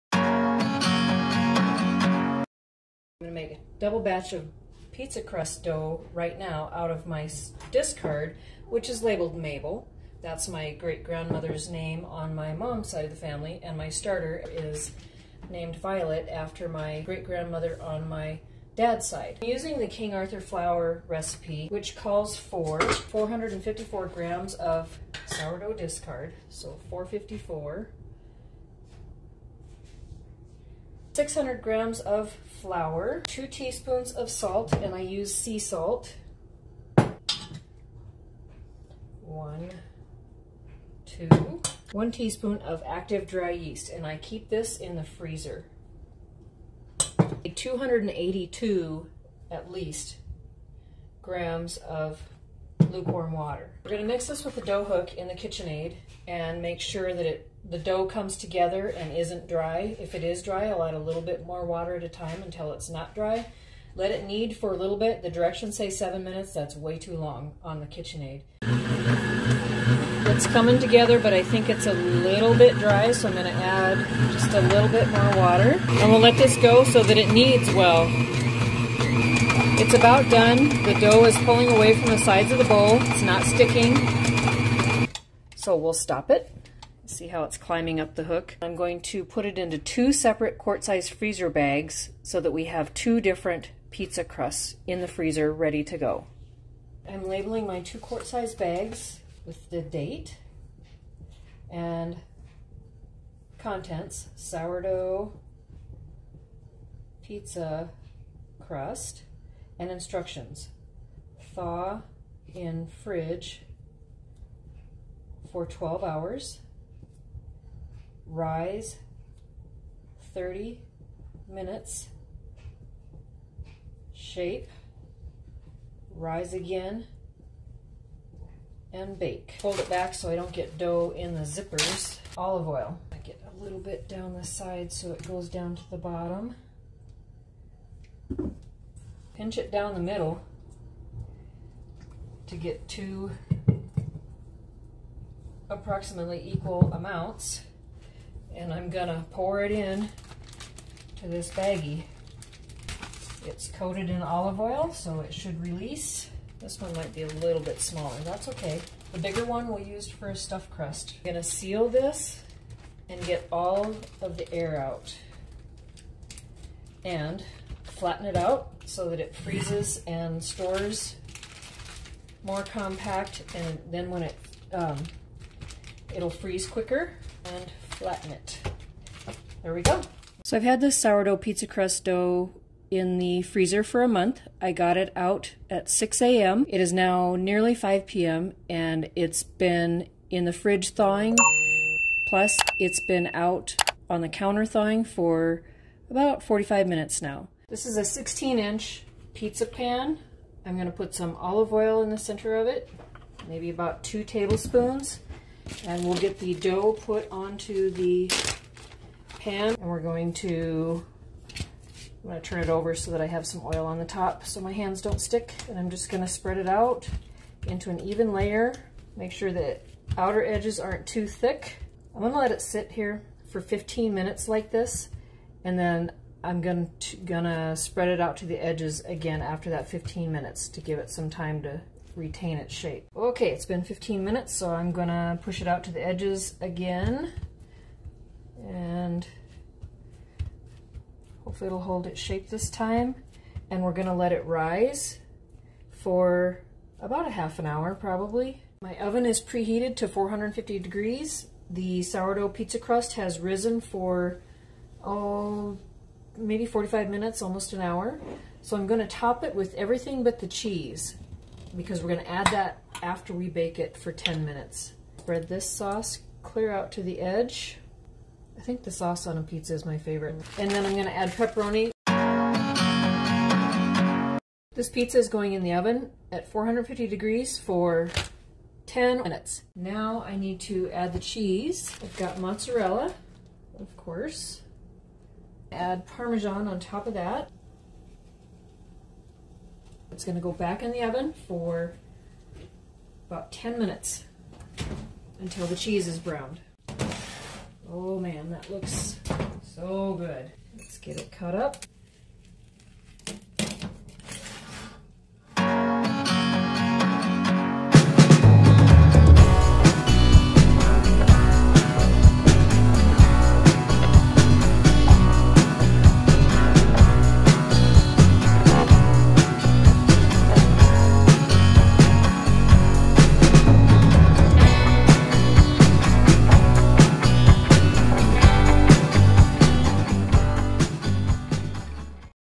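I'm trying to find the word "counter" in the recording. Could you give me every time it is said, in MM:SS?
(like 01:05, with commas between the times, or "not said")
03:14.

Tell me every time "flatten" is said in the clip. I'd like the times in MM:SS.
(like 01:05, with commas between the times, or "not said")
02:48, 02:57.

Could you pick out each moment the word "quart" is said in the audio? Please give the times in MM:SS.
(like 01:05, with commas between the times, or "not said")
01:30, 01:37.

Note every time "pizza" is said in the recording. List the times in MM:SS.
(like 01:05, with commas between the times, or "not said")
00:04, 01:33, 01:47, 03:01, 03:19, 04:12, 04:29, 04:34.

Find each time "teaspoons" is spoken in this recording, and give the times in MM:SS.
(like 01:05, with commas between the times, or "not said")
00:33, 00:42.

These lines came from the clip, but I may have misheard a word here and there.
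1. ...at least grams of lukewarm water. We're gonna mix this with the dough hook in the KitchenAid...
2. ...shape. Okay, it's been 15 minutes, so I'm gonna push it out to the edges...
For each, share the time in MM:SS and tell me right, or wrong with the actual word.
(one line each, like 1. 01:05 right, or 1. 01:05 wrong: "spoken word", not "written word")
1. 00:49 right
2. 03:52 right.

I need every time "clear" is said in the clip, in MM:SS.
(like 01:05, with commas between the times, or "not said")
04:26.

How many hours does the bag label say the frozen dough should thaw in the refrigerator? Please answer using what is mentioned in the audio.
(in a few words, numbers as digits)
12.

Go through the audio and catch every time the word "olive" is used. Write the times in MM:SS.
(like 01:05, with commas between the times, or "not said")
02:12, 02:34, 03:21.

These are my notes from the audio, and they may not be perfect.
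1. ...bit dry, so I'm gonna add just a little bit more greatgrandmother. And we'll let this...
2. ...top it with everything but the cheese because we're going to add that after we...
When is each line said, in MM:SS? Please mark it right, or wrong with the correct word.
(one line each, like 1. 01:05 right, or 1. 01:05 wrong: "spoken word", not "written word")
1. 01:12 wrong: "water", not "greatgrandmother"
2. 04:19 right.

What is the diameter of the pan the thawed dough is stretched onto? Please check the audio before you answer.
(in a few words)
16 inch.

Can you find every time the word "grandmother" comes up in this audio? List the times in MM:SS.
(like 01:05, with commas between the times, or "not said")
00:10, 00:17.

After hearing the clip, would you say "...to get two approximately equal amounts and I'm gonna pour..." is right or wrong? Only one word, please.
right.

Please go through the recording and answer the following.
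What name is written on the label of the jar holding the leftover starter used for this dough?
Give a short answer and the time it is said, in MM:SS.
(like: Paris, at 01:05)
Mabel, at 00:09.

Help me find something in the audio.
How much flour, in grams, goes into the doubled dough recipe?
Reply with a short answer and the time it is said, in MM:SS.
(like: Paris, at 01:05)
600 grams, at 00:31.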